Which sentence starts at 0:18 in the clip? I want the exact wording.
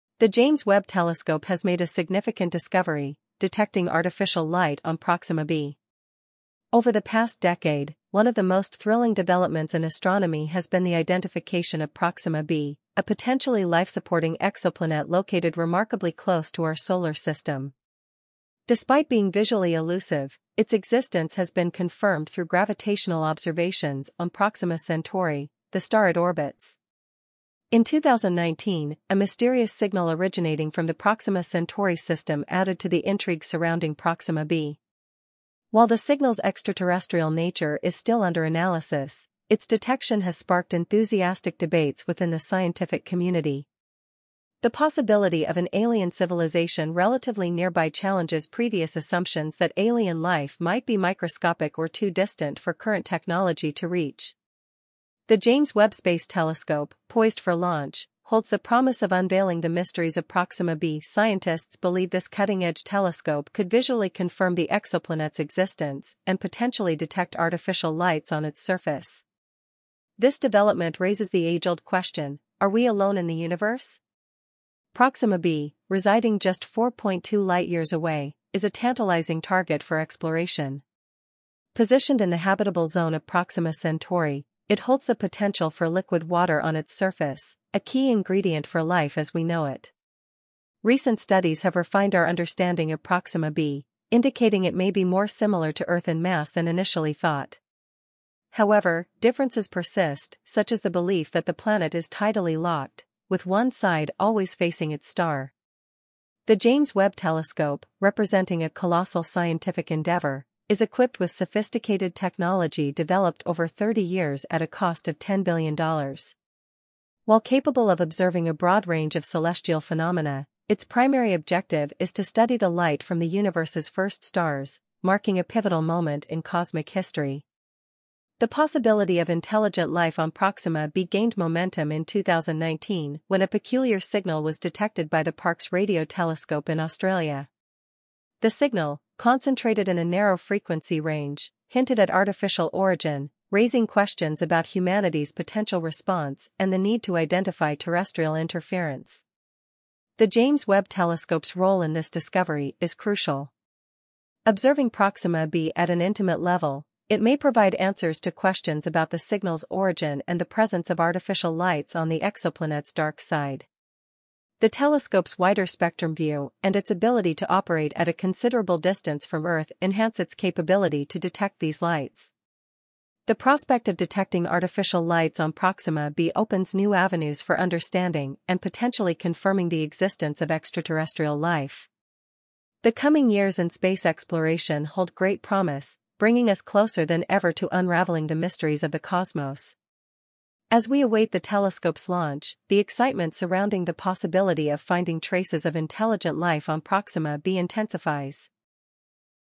Despite being visually elusive, its existence has been confirmed through gravitational observations on Proxima Centauri, the star it orbits.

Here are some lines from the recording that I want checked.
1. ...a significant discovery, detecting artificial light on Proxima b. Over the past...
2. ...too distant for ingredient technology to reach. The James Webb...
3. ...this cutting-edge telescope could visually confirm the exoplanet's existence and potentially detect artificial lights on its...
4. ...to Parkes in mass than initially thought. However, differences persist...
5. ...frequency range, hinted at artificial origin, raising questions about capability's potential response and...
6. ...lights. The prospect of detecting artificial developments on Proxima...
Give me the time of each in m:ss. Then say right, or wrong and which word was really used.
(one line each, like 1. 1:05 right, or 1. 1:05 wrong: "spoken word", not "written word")
1. 0:01 right
2. 0:51 wrong: "current", not "ingredient"
3. 1:02 right
4. 1:35 wrong: "Earth", not "Parkes"
5. 2:20 wrong: "humanity", not "capability"
6. 2:51 wrong: "lights", not "developments".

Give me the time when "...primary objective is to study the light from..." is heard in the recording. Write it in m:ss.
2:00.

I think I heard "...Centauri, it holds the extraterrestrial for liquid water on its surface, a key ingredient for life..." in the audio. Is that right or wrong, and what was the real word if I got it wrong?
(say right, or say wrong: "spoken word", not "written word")
wrong: "potential", not "extraterrestrial".